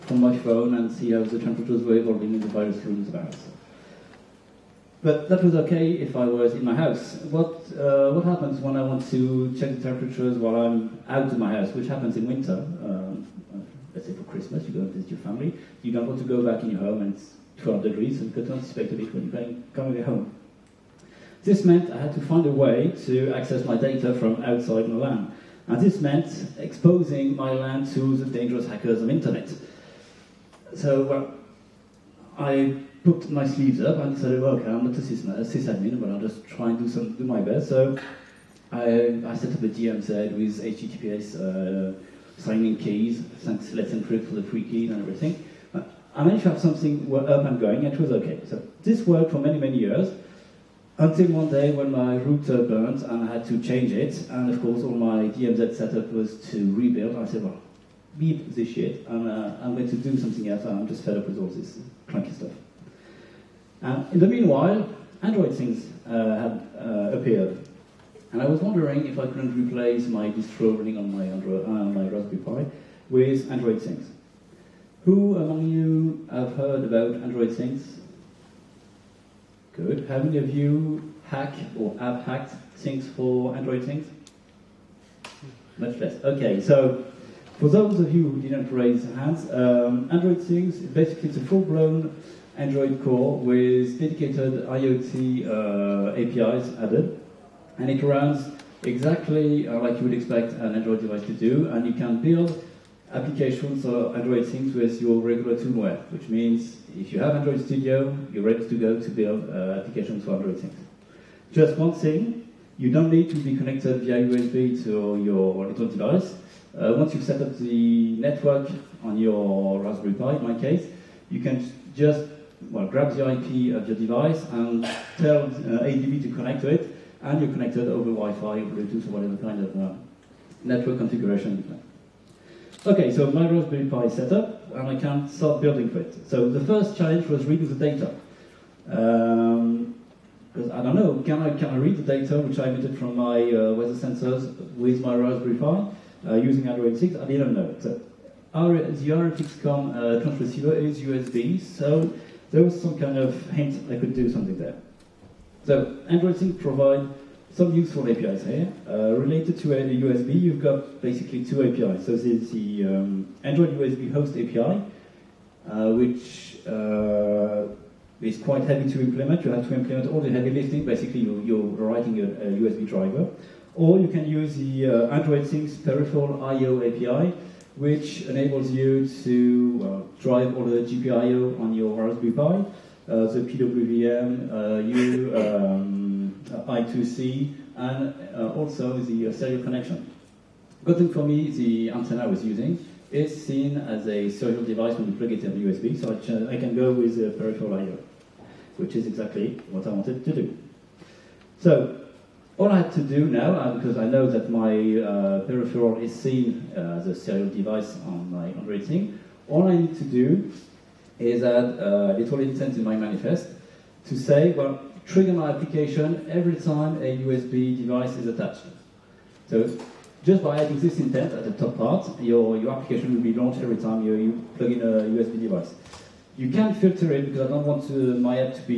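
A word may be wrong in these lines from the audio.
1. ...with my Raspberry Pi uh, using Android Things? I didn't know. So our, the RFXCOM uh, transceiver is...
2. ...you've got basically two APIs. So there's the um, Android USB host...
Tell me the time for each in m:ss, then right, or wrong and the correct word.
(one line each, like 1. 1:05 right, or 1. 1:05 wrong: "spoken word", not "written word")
1. 2:24 right
2. 2:40 right.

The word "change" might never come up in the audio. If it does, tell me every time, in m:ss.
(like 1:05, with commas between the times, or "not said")
0:53.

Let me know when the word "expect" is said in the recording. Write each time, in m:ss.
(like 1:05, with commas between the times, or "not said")
0:18, 1:40.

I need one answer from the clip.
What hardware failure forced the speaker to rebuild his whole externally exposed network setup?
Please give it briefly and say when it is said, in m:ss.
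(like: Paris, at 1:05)
router burnt, at 0:52.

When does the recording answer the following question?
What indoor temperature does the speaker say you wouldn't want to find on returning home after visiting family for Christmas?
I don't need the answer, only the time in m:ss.
0:17.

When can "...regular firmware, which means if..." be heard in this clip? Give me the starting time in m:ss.
1:45.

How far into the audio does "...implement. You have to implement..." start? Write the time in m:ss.
2:49.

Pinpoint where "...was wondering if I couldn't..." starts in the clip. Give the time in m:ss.
1:08.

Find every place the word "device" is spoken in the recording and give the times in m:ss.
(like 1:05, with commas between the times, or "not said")
1:41, 1:55, 2:03, 3:14, 3:27, 3:37, 3:45.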